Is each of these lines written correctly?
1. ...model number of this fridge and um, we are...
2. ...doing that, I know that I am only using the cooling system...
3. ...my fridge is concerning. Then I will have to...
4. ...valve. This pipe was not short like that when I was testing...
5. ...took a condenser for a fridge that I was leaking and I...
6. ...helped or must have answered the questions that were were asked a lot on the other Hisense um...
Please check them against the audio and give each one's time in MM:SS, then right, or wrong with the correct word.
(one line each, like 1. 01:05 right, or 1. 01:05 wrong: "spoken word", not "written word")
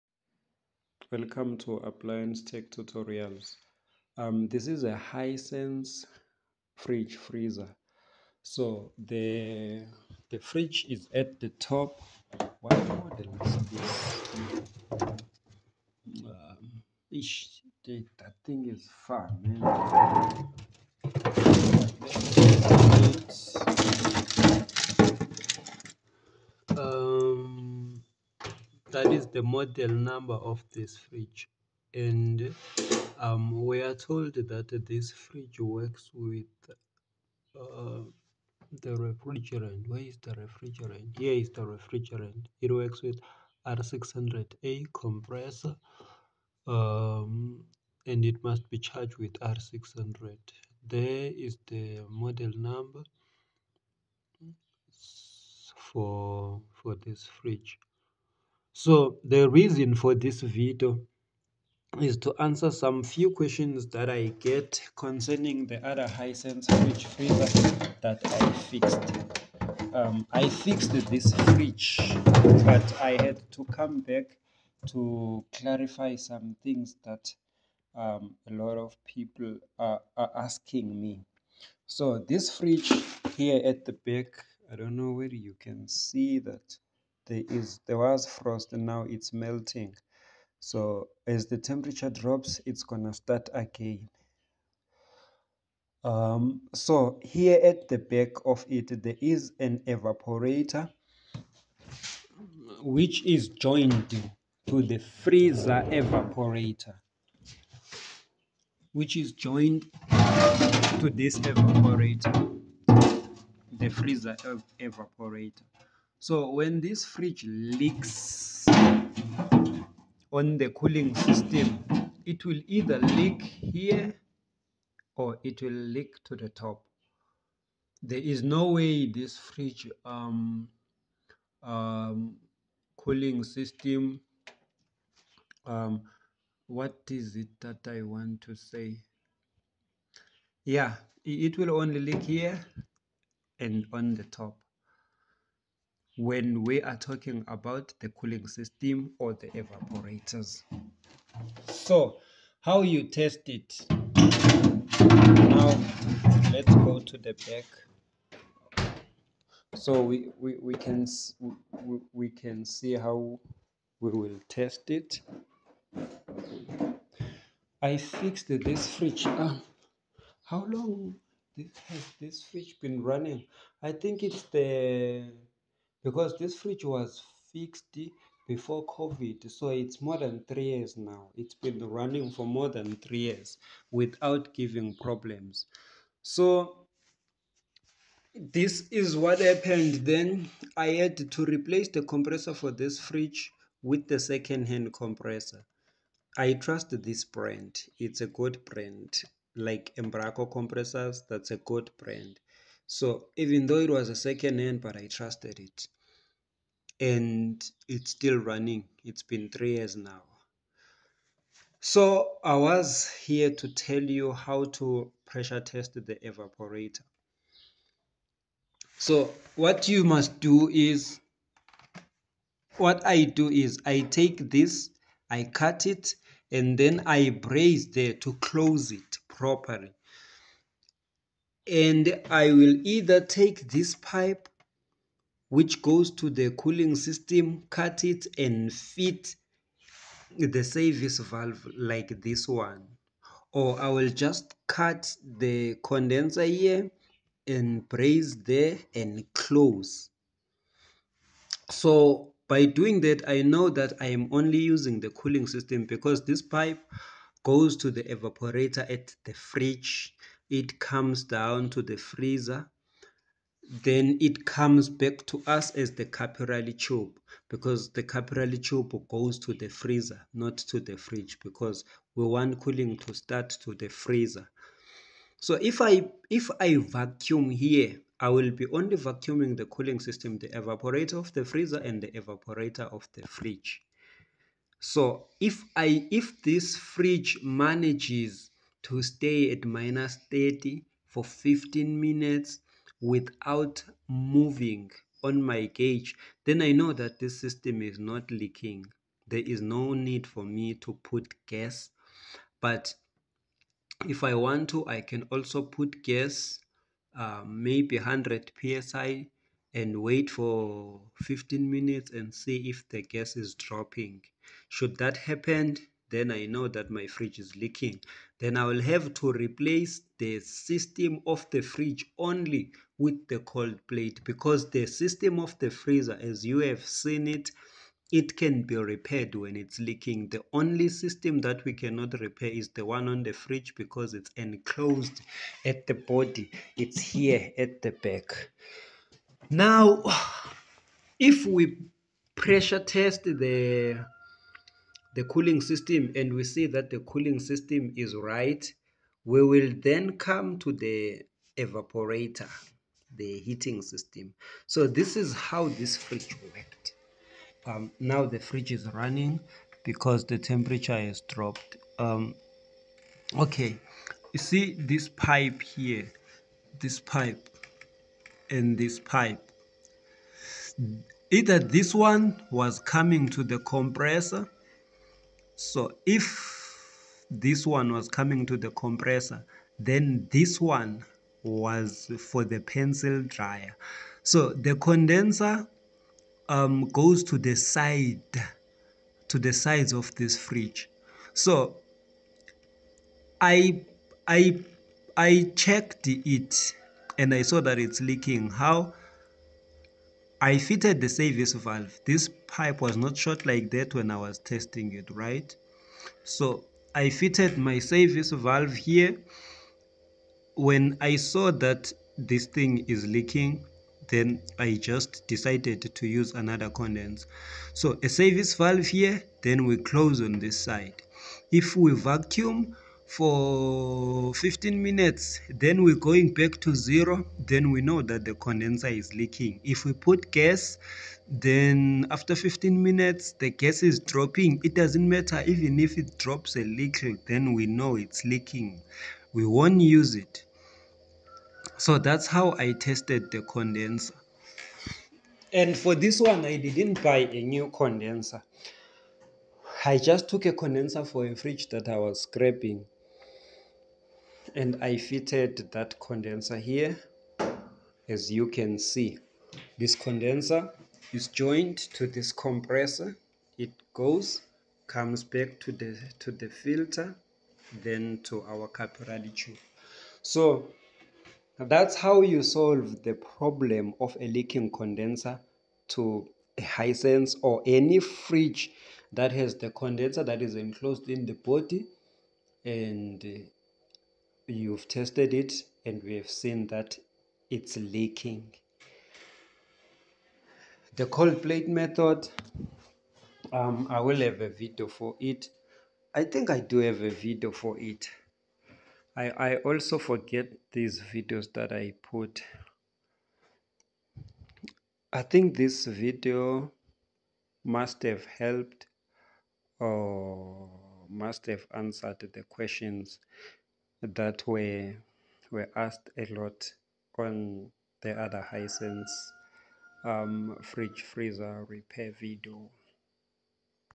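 1. 00:29 right
2. 04:12 right
3. 05:16 wrong: "leaking", not "concerning"
4. 06:41 right
5. 07:30 wrong: "scraping", not "leaking"
6. 08:28 right.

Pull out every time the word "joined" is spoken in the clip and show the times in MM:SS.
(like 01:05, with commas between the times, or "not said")
01:43, 01:49, 07:41.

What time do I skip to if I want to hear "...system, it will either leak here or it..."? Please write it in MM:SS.
02:01.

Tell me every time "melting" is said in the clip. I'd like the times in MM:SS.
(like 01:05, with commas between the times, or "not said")
01:29.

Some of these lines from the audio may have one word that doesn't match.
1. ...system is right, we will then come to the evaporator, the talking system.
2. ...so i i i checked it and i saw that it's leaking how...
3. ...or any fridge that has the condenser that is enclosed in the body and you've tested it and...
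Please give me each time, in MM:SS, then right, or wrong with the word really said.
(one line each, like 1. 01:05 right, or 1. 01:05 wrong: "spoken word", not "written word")
1. 05:47 wrong: "heating", not "talking"
2. 06:31 right
3. 07:57 right.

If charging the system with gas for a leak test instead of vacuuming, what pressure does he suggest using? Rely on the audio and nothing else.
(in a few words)
100 psi.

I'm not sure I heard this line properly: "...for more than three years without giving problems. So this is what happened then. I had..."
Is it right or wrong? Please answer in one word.
right.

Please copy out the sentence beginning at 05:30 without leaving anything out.
The only system that we cannot repair is the one on the fridge because it's enclosed at the body.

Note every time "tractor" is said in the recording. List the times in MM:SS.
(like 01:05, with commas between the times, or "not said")
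not said.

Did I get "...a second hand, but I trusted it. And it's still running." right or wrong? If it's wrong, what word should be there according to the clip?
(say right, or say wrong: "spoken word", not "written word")
right.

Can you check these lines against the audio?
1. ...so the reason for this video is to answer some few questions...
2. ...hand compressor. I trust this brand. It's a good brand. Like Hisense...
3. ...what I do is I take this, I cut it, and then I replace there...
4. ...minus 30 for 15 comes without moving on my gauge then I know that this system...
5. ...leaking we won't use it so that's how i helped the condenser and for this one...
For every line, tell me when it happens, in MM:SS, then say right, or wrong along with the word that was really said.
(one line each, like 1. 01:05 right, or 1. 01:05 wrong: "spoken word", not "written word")
1. 00:58 right
2. 03:14 wrong: "Embraco", not "Hisense"
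3. 03:42 wrong: "brace", not "replace"
4. 04:49 wrong: "minutes", not "comes"
5. 07:18 wrong: "tested", not "helped".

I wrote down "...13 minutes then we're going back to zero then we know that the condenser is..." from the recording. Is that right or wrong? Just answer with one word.
wrong.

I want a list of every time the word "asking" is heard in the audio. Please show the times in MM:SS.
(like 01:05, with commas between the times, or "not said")
01:20.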